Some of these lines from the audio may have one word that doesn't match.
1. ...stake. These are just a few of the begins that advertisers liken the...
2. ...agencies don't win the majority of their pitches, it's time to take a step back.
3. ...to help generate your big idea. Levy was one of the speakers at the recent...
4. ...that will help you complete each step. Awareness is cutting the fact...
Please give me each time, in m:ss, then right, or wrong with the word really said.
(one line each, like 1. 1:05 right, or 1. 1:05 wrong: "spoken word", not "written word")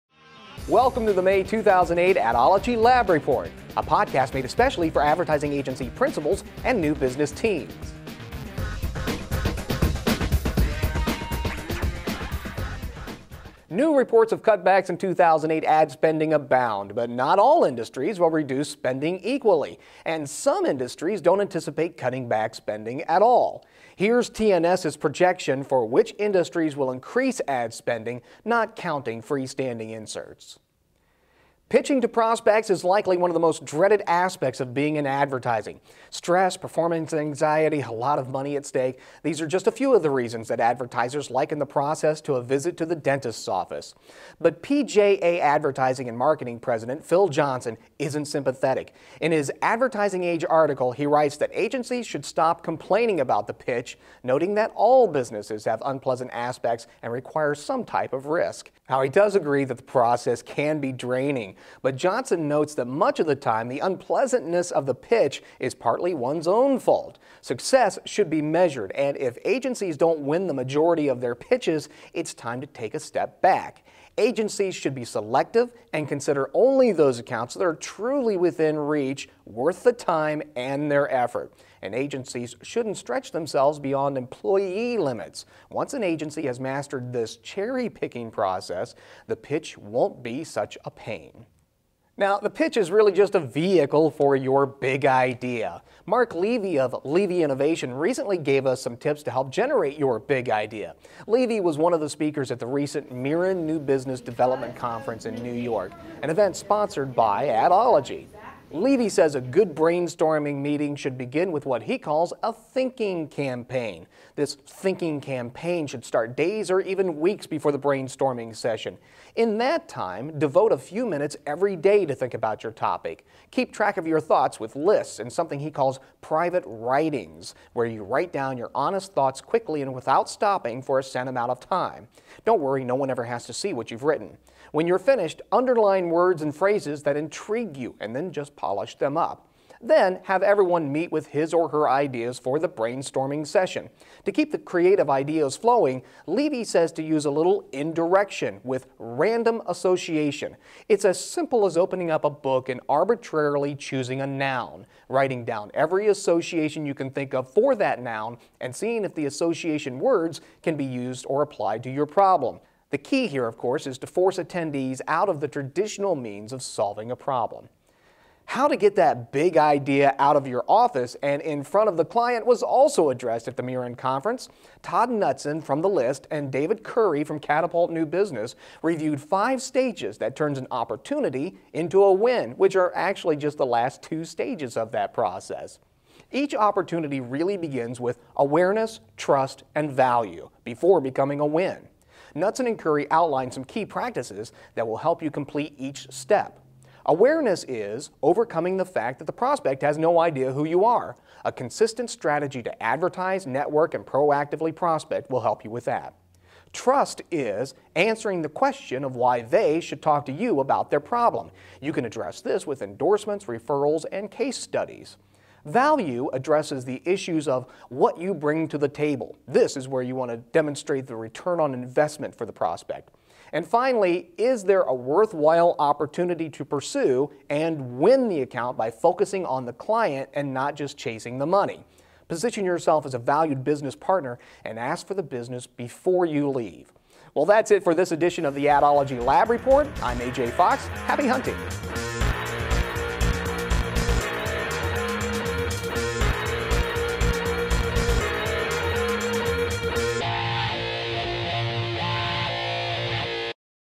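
1. 0:38 wrong: "reasons", not "begins"
2. 1:09 right
3. 1:39 right
4. 3:14 wrong: "overcoming", not "cutting".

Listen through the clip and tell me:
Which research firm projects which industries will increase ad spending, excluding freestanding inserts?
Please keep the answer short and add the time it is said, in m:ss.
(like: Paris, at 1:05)
TNS, at 0:24.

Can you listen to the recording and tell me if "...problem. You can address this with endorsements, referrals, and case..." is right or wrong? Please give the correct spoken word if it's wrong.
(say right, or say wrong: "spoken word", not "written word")
right.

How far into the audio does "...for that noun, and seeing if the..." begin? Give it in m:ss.
2:37.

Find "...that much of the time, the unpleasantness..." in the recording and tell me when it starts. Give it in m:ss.
1:02.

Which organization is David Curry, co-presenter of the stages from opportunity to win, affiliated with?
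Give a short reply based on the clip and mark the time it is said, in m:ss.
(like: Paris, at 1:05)
Catapult New Business, at 2:57.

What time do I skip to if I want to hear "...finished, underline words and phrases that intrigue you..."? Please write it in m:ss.
2:14.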